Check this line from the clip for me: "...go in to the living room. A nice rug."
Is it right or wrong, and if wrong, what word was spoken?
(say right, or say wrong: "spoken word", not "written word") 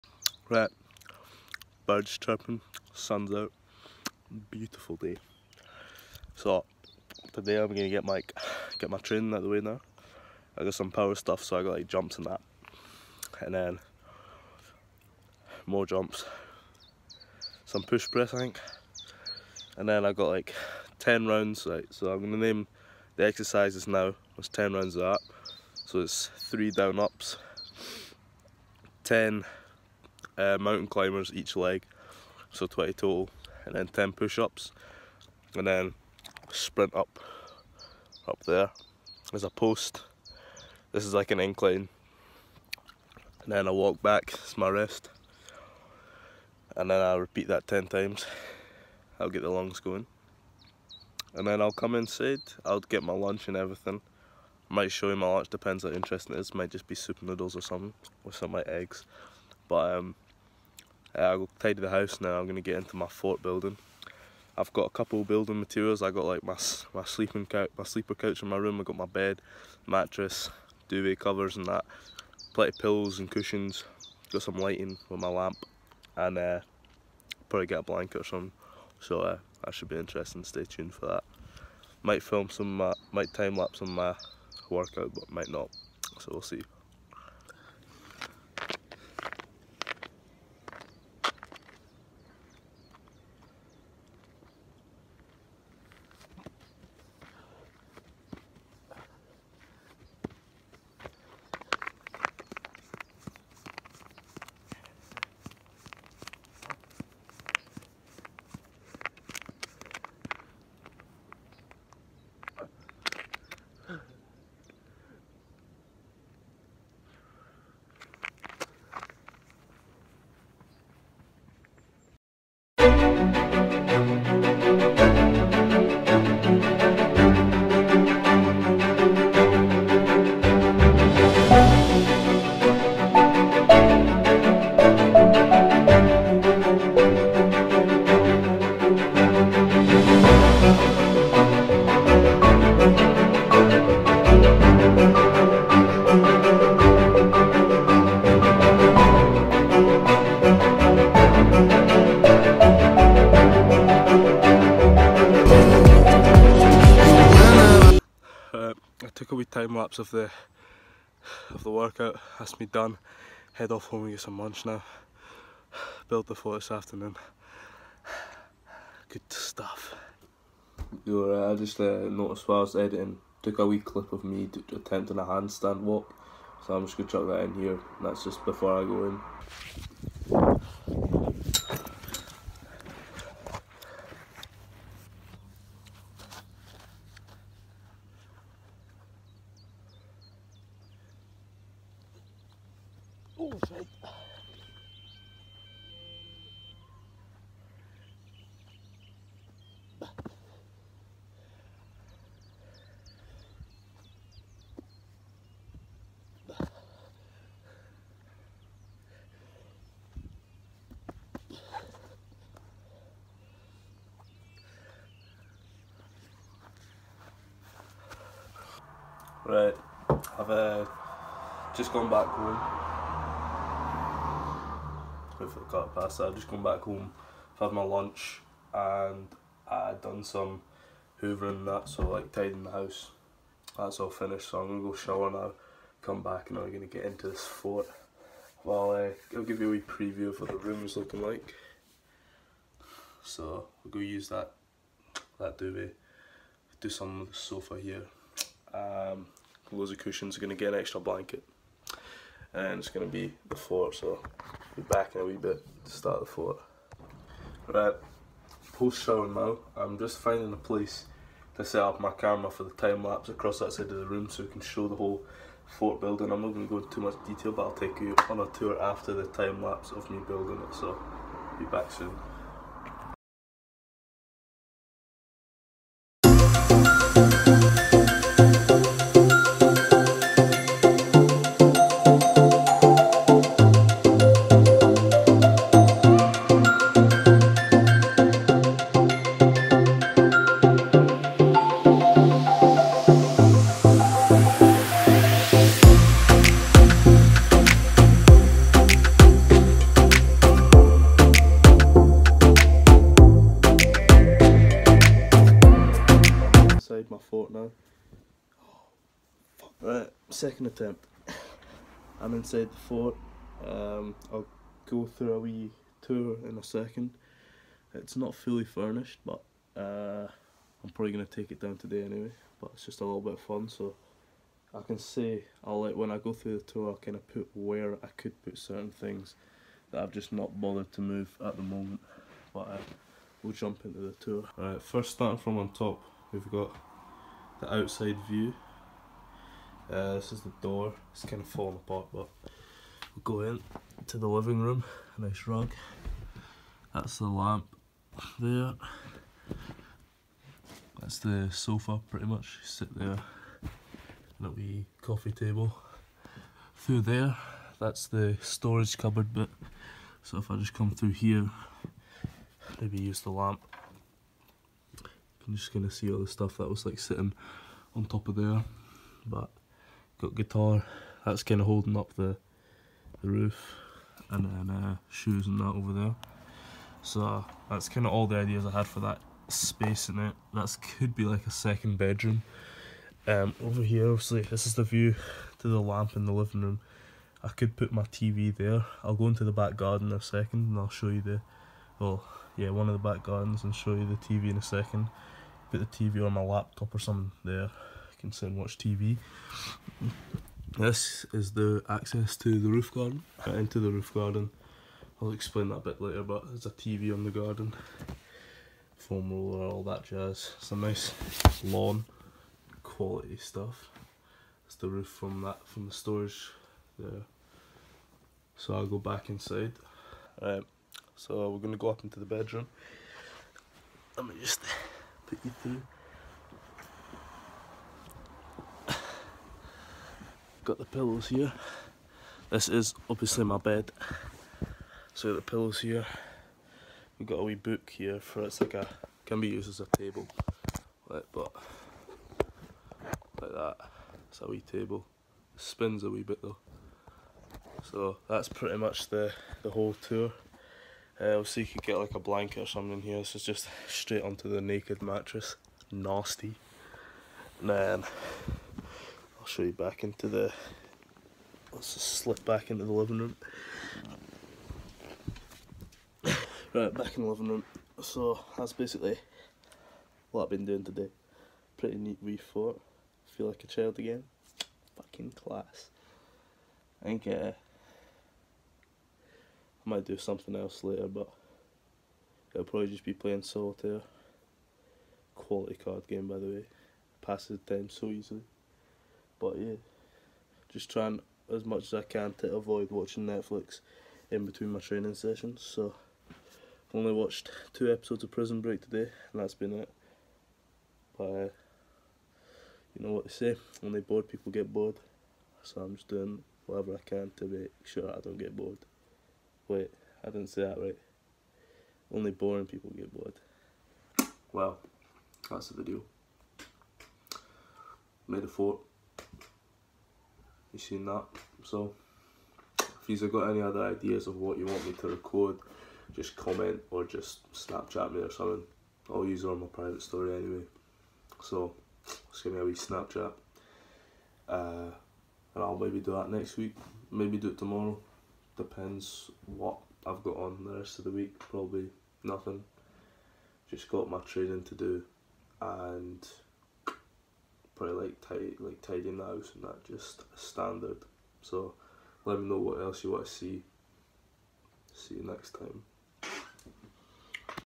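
right.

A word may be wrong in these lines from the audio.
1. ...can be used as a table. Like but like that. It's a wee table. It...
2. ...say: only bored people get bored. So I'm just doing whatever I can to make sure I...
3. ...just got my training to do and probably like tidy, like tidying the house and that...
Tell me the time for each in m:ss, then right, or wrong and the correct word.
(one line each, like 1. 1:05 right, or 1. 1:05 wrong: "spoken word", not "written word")
1. 7:19 right
2. 8:23 right
3. 9:03 right.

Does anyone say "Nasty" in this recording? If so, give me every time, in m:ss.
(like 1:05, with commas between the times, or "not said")
7:35.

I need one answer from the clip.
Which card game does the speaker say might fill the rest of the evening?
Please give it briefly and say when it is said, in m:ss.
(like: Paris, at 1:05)
Solitaire, at 8:03.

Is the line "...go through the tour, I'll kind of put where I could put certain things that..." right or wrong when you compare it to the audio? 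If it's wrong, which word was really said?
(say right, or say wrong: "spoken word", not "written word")
right.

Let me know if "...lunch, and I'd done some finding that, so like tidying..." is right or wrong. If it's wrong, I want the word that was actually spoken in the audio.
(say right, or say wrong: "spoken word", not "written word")
wrong: "hoovering", not "finding".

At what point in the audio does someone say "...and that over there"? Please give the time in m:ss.
6:15.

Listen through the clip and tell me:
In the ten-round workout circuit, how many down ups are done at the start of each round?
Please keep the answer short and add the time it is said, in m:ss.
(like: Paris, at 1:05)
3, at 0:26.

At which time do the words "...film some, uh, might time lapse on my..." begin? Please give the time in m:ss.
1:22.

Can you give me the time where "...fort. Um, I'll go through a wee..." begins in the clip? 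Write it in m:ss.
5:12.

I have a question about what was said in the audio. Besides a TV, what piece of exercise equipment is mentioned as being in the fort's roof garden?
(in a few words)
Foam roller.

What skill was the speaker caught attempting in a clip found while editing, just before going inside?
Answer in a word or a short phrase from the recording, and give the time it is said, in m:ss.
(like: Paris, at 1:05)
Handstand walk, at 2:55.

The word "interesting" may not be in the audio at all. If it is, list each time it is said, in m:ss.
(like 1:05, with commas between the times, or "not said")
0:55, 1:19.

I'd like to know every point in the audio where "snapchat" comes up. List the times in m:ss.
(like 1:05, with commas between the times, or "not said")
8:47, 8:52.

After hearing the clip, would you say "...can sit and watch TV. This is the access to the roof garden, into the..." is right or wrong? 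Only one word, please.
right.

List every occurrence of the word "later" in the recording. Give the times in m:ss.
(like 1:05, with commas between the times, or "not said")
6:46, 8:00.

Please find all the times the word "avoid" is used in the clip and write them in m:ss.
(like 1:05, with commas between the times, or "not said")
8:12.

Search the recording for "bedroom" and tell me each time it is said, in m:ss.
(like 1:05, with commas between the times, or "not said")
6:21, 7:02.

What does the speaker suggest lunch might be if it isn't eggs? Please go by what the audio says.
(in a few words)
Soup noodles.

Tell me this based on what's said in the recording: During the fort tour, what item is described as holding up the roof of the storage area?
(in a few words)
Guitar.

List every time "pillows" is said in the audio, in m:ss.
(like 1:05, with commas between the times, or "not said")
1:12, 7:10, 7:15.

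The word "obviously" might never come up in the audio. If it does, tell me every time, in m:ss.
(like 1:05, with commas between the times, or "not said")
6:24, 7:13, 7:31.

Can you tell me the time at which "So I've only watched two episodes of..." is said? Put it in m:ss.
8:15.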